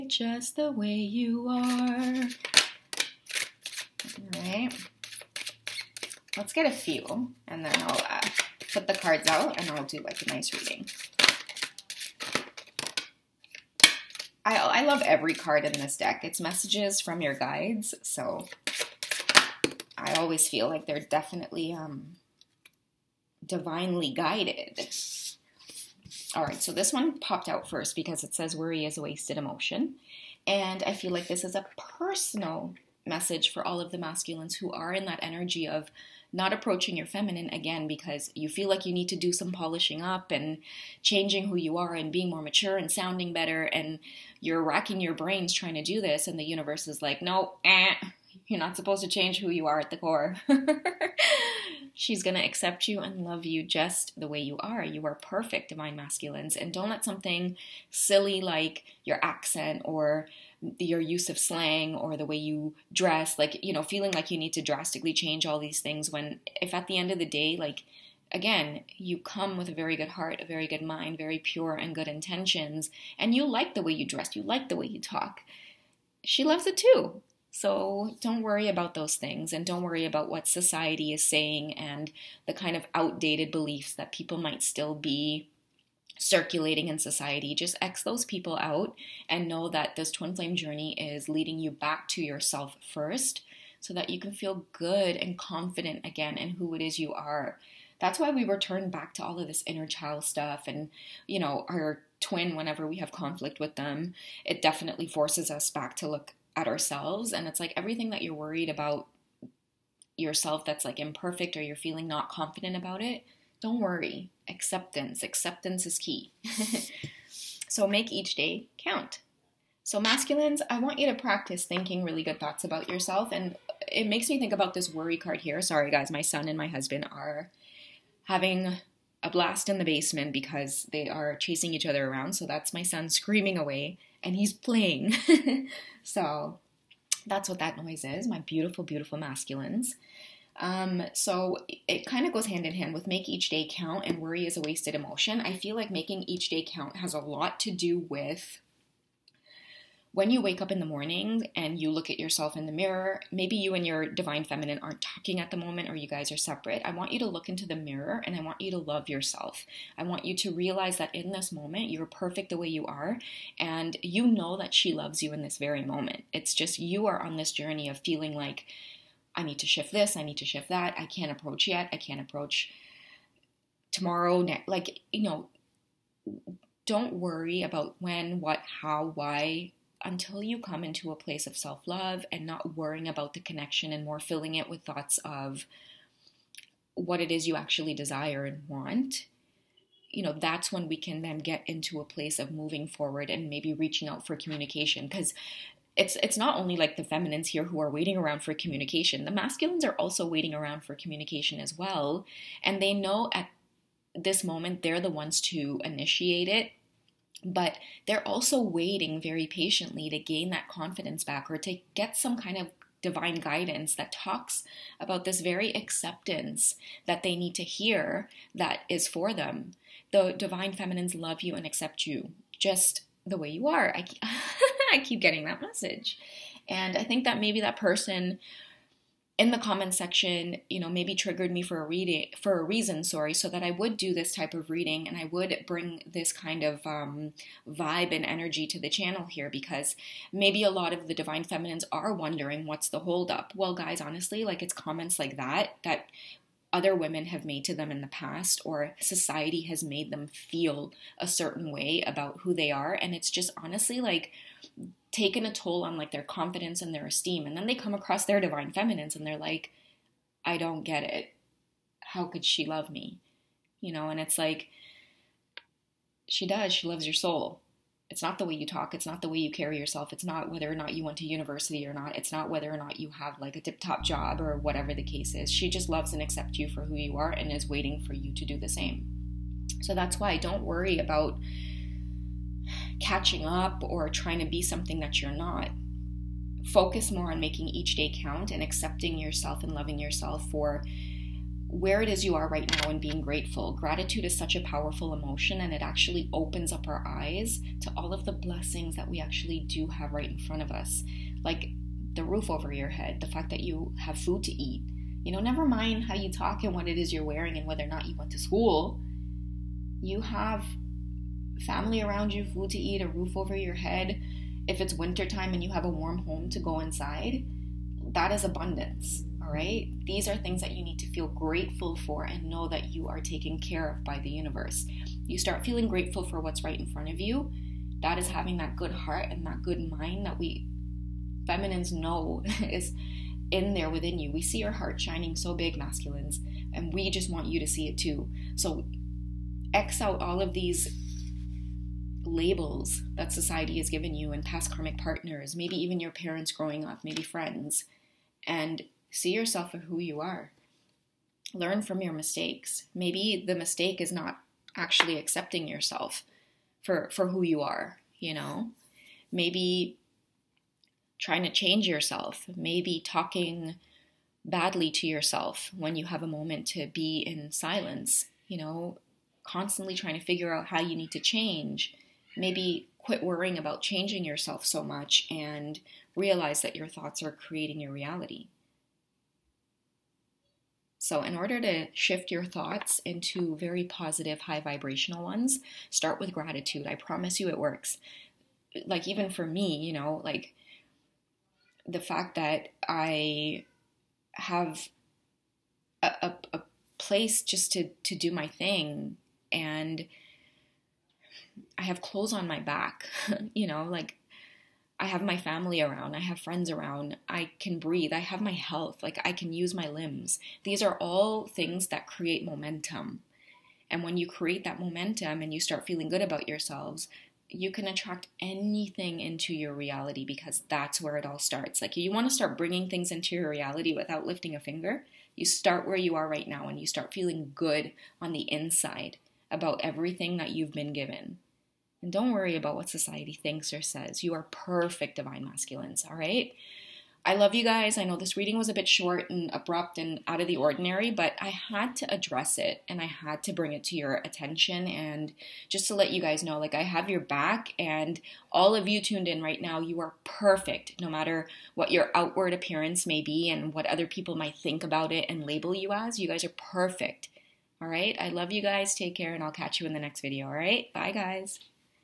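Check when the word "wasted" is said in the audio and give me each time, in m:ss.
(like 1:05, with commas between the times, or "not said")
0:29, 2:24.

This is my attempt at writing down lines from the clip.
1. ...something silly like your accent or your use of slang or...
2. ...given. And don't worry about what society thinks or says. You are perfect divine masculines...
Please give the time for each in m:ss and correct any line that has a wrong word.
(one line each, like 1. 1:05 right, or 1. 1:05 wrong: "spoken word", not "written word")
1. 0:57 right
2. 7:10 right.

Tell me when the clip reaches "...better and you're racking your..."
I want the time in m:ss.
0:43.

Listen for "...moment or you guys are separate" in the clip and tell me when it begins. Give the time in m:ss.
2:35.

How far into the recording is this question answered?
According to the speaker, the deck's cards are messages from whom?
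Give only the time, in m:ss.
0:16.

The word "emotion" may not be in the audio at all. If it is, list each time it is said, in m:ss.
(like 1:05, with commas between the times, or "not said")
0:29, 2:24, 4:55.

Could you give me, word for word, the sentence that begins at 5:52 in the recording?
Maybe the mistake is not actually accepting yourself for, for who you are, you know?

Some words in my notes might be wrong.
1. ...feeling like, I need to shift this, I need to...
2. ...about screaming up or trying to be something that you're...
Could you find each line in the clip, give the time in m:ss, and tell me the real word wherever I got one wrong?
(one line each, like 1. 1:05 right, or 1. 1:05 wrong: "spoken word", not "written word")
1. 2:47 right
2. 4:40 wrong: "catching", not "screaming".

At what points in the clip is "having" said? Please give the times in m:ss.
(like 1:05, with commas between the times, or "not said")
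2:08, 5:28.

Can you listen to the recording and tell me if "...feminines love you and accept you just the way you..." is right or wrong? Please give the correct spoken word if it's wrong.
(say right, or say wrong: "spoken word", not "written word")
right.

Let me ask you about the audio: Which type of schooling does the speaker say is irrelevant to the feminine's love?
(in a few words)
University.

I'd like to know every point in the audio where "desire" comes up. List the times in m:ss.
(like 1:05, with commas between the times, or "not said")
3:07.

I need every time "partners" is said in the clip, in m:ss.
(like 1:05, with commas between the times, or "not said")
5:44.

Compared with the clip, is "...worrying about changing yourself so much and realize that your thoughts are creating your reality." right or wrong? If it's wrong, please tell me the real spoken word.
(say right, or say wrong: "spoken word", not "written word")
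right.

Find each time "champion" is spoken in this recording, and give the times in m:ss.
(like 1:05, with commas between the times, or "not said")
not said.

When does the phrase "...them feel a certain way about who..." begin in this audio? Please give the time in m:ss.
4:10.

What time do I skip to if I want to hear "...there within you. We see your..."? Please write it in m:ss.
5:33.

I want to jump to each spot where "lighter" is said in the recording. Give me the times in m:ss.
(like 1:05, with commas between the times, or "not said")
not said.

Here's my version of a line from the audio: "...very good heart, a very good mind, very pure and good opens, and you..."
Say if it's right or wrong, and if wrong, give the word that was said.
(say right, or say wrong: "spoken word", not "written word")
wrong: "intentions", not "opens".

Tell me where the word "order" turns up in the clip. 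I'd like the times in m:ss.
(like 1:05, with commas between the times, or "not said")
6:21.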